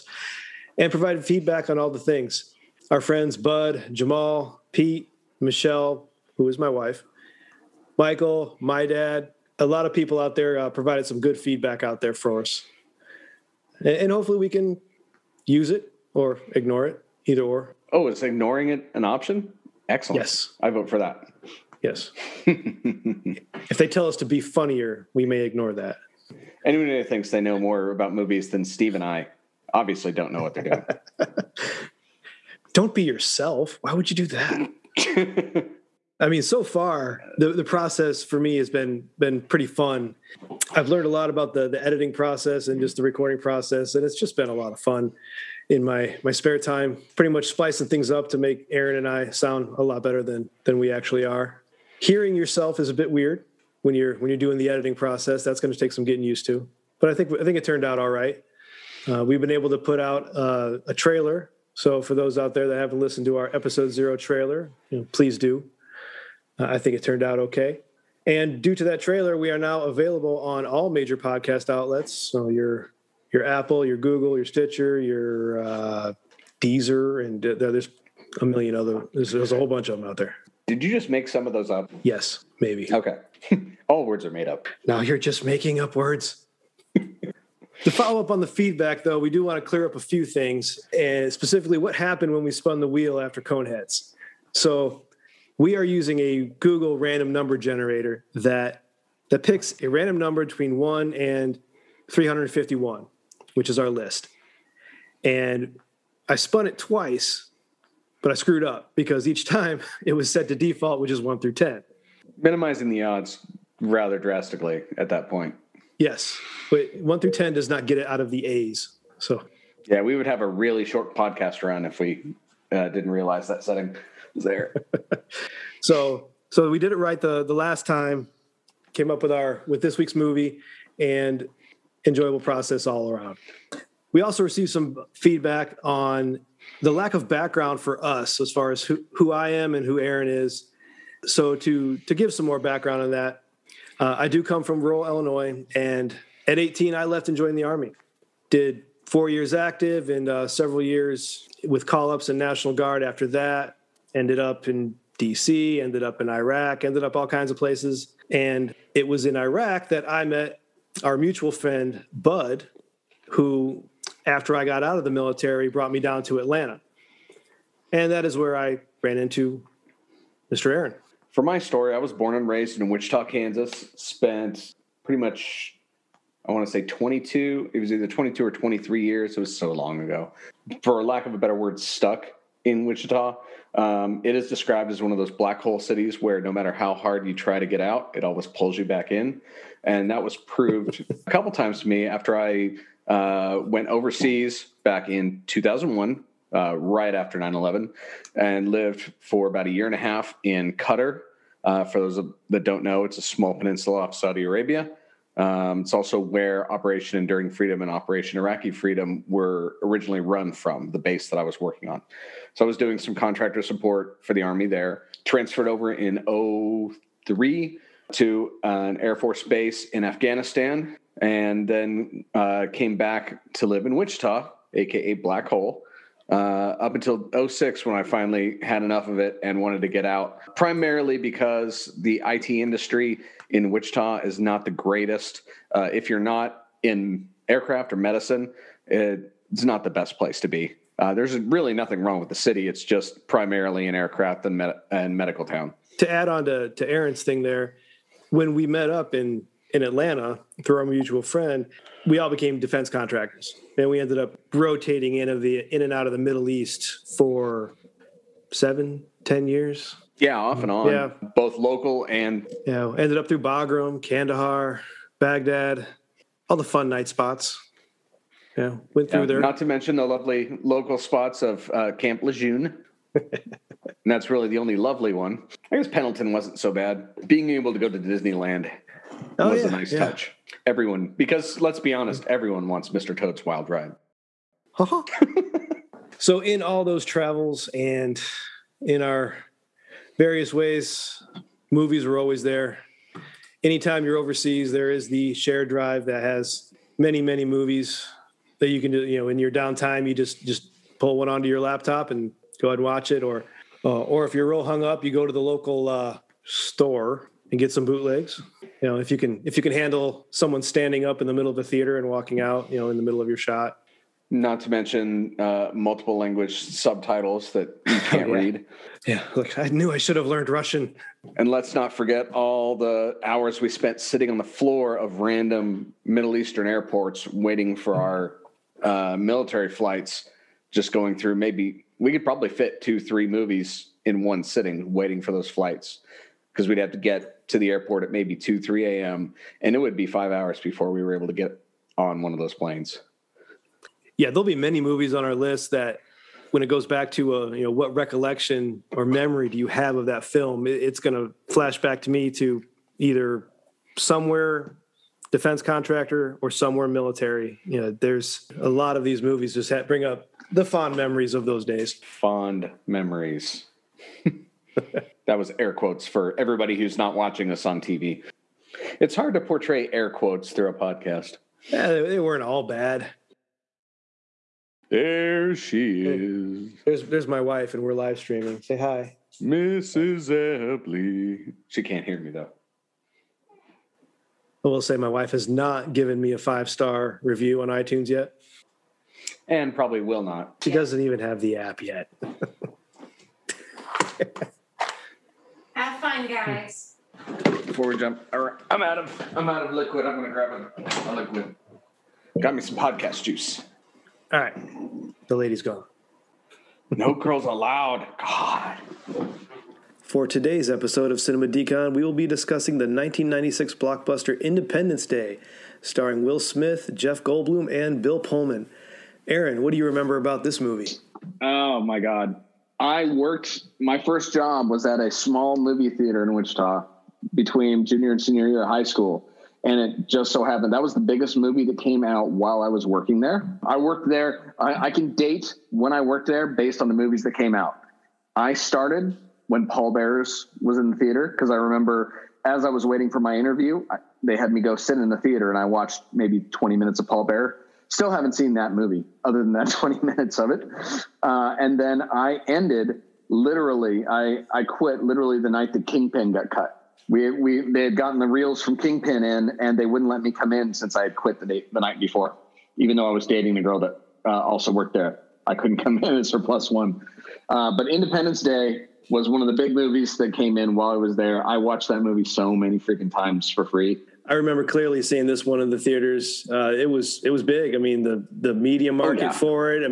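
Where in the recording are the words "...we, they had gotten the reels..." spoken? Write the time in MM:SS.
07:37.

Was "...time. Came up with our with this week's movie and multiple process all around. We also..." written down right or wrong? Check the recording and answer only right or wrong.
wrong.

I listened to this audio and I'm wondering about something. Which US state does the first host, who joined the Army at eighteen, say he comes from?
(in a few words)
Illinois.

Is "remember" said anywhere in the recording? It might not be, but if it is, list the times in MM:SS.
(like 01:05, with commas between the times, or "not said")
06:59, 07:21, 07:54.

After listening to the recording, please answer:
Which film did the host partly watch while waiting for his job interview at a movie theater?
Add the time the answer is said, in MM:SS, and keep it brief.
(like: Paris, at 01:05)
Pallbearers, at 07:19.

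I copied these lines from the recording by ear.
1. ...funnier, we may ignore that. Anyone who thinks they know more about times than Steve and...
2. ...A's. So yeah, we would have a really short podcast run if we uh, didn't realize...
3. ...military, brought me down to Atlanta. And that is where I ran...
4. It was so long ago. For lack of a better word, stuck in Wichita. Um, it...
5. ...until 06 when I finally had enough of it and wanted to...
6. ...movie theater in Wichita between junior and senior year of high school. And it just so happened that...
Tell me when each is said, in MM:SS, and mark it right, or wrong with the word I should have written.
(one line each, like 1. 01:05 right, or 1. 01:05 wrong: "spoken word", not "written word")
1. 00:24 wrong: "movies", not "times"
2. 01:58 right
3. 02:45 right
4. 02:59 right
5. 03:46 right
6. 07:05 right.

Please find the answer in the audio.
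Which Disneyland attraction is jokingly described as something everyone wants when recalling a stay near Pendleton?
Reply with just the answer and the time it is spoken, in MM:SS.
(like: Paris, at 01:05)
Mr. Toad's Wild Ride, at 04:42.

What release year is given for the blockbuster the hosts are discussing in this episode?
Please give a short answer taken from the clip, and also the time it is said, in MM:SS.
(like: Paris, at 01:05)
1996, at 06:52.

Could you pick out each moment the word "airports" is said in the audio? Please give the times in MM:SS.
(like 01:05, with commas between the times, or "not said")
05:26, 05:37.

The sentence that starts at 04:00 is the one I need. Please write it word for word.
Uh, there's really nothing wrong with the city.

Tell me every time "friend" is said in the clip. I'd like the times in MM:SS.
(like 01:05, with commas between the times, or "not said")
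00:03, 02:41, 04:11.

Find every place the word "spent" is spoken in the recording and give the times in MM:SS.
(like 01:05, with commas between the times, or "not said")
02:53, 05:23.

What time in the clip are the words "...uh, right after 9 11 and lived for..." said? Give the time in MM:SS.
03:16.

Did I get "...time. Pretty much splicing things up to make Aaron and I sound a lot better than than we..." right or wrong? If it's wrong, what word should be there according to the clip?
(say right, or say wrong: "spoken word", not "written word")
right.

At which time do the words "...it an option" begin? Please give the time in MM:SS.
00:18.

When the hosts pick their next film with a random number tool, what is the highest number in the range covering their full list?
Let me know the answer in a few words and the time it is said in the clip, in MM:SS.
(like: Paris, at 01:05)
351, at 01:42.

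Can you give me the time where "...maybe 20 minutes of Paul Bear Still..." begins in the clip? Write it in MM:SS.
07:26.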